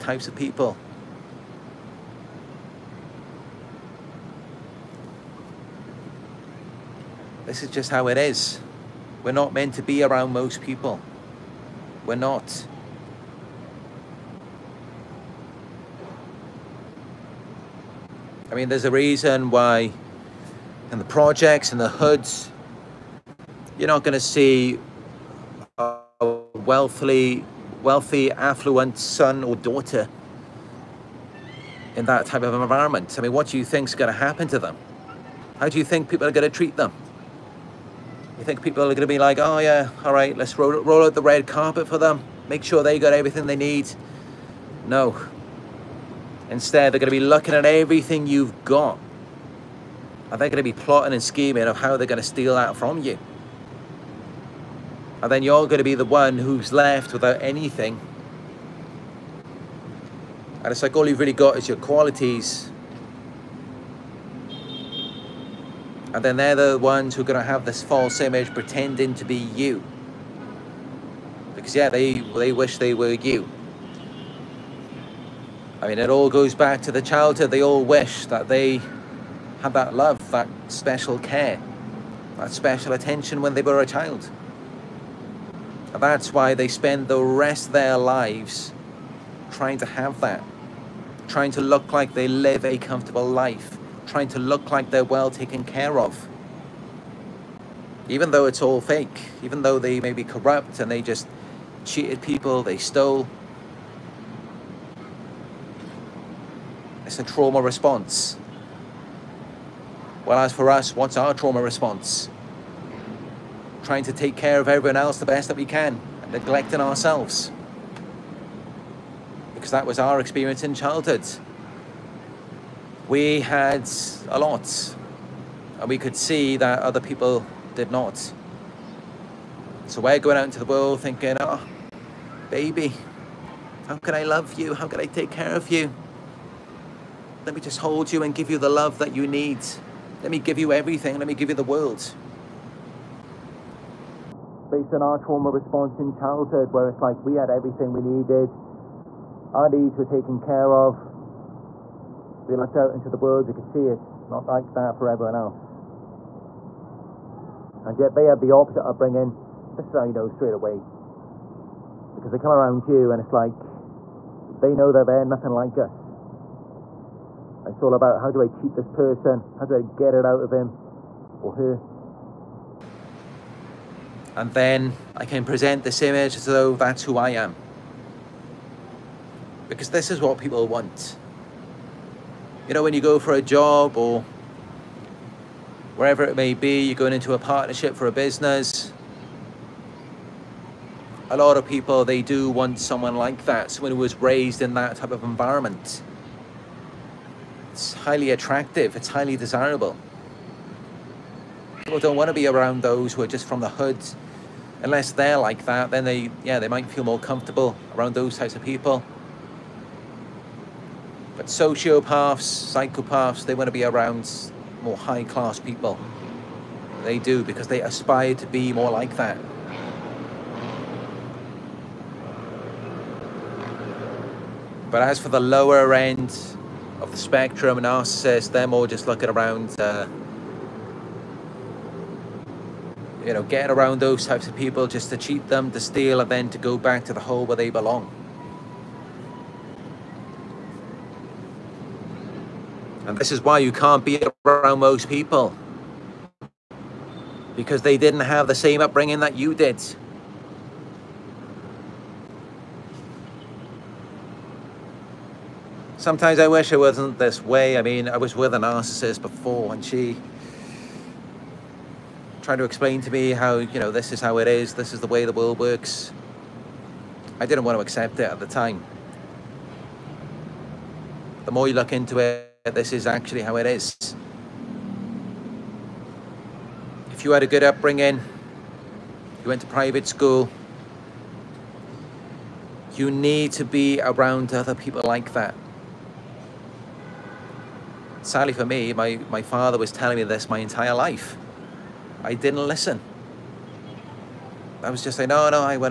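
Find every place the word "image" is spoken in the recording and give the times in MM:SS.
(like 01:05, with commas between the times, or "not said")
01:08, 02:56.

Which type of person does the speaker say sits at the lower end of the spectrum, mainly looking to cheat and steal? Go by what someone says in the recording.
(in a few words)
narcissists.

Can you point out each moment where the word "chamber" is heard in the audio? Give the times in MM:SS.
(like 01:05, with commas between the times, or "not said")
not said.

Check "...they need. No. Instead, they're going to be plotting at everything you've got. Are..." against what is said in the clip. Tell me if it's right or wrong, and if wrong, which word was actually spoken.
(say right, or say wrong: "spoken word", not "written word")
wrong: "looking", not "plotting".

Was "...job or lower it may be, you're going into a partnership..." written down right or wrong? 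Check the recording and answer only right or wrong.
wrong.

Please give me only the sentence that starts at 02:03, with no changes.
We had a lot, and we could see that other people did not.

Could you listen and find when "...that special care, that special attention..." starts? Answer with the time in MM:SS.
01:20.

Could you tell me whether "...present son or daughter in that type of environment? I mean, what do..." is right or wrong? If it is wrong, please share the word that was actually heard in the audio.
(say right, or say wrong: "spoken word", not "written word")
wrong: "affluent", not "present".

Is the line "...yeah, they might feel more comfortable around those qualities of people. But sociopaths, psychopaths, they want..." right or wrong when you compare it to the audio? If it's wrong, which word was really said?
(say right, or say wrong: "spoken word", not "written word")
wrong: "types", not "qualities".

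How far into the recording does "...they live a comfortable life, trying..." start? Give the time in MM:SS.
01:32.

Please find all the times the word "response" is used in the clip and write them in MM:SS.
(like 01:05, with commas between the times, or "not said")
01:47, 01:51, 02:25.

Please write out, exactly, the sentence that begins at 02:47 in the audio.
It's all about how do I cheat this person?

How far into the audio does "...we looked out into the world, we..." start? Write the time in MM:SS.
02:32.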